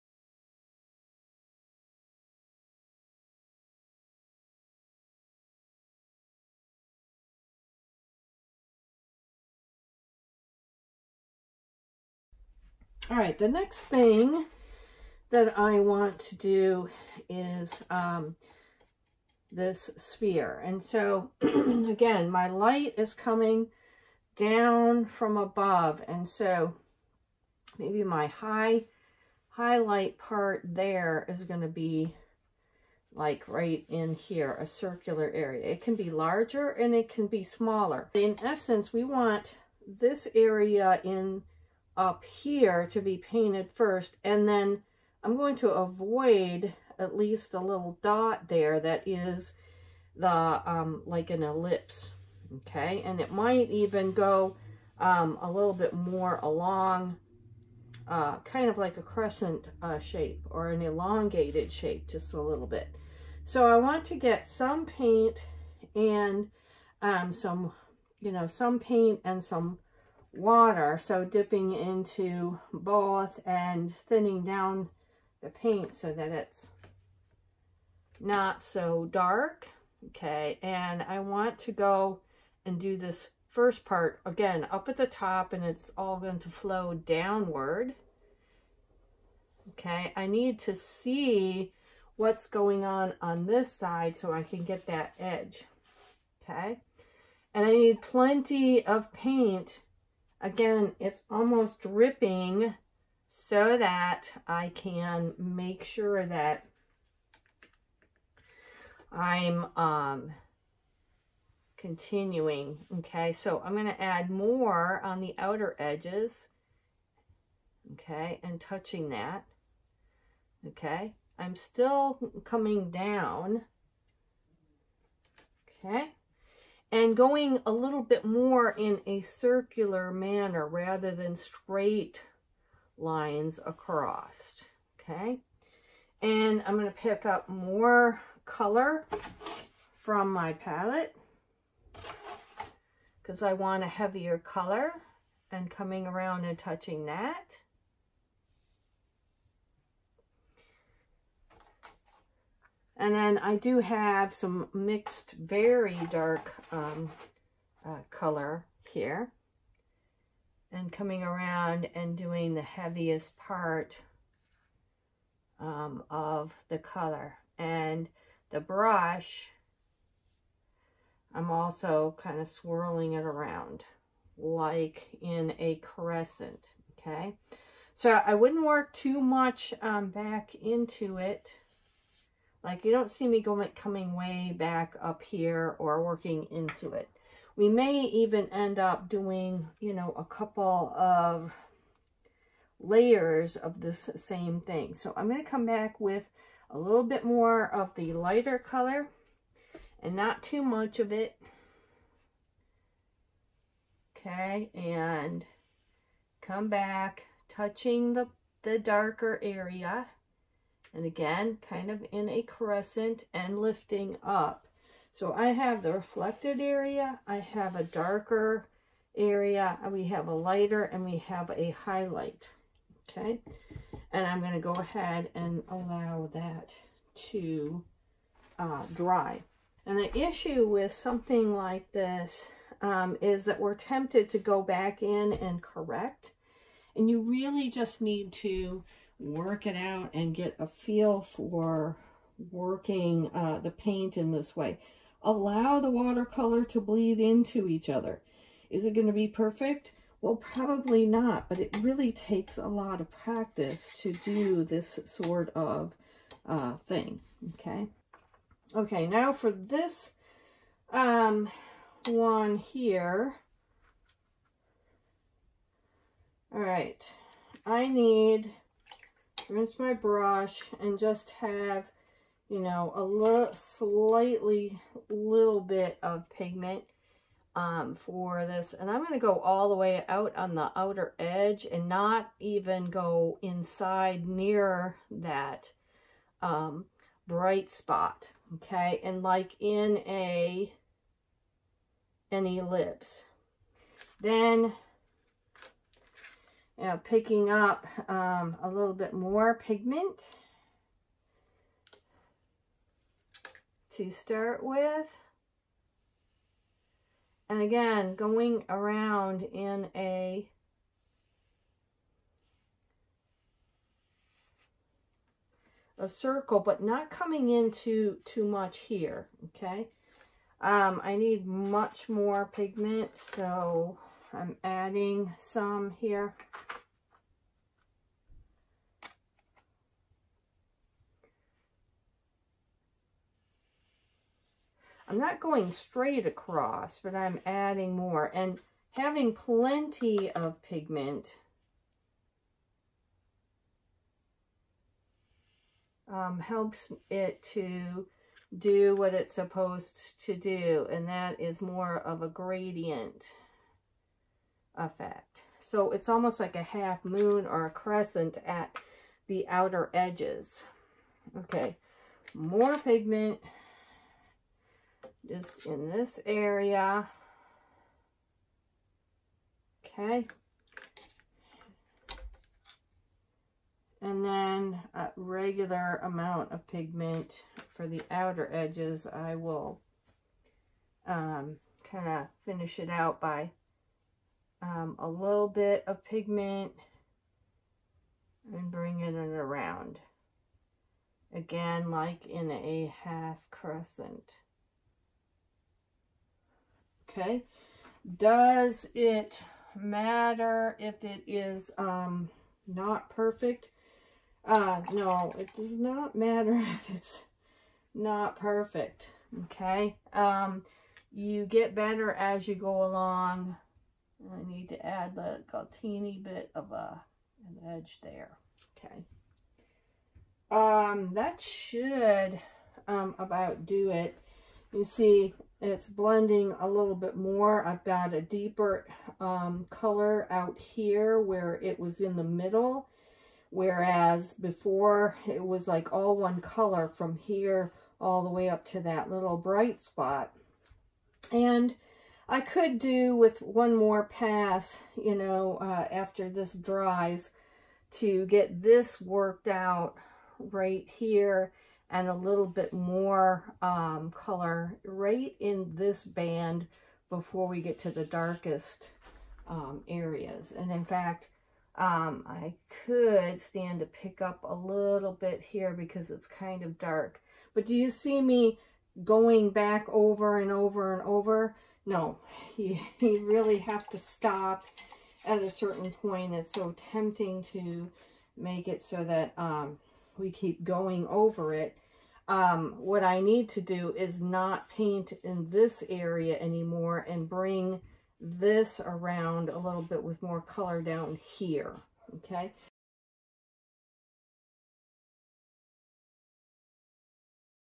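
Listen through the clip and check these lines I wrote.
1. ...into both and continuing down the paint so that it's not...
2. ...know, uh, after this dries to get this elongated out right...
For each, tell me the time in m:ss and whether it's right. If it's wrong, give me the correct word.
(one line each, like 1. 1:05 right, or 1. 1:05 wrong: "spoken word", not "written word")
1. 1:11 wrong: "thinning", not "continuing"
2. 7:25 wrong: "worked", not "elongated".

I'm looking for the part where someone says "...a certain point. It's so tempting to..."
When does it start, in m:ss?
7:55.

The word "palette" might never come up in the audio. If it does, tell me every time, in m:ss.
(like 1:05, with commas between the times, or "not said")
2:20.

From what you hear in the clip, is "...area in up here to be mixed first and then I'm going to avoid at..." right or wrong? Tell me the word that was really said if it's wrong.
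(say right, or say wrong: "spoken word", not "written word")
wrong: "painted", not "mixed".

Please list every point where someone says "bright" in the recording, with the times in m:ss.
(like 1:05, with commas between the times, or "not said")
4:47, 7:19.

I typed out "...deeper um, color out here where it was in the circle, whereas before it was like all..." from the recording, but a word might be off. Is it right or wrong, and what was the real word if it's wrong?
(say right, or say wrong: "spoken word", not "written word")
wrong: "middle", not "circle".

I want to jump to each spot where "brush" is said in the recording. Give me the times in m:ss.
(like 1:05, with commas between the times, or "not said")
2:48, 4:29.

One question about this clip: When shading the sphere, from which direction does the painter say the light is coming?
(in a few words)
from above.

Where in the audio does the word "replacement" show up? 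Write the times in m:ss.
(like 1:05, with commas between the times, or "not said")
not said.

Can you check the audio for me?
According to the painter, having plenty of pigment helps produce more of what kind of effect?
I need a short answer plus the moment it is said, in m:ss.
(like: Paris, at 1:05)
gradient effect, at 5:52.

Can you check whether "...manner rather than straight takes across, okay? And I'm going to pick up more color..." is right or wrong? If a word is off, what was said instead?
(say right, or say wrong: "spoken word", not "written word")
wrong: "lines", not "takes".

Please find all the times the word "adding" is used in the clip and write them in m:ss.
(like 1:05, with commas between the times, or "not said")
5:24, 5:37.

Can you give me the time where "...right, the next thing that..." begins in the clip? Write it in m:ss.
0:13.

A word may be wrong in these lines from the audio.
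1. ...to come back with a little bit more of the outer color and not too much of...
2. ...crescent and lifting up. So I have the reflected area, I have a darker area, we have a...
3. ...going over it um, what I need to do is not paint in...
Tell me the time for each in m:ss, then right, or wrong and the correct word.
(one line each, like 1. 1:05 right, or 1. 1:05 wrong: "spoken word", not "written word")
1. 3:15 wrong: "lighter", not "outer"
2. 3:32 right
3. 8:00 right.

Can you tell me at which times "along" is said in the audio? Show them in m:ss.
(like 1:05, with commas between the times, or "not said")
0:56, 6:52.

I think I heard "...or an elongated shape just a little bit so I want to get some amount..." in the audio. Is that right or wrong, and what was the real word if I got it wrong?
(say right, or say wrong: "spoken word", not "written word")
wrong: "paint", not "amount".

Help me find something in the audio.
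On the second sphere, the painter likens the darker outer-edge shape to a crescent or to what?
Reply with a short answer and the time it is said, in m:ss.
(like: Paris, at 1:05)
a half moon, at 5:56.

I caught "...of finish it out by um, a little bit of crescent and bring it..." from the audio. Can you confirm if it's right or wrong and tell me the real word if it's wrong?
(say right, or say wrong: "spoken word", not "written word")
wrong: "pigment", not "crescent".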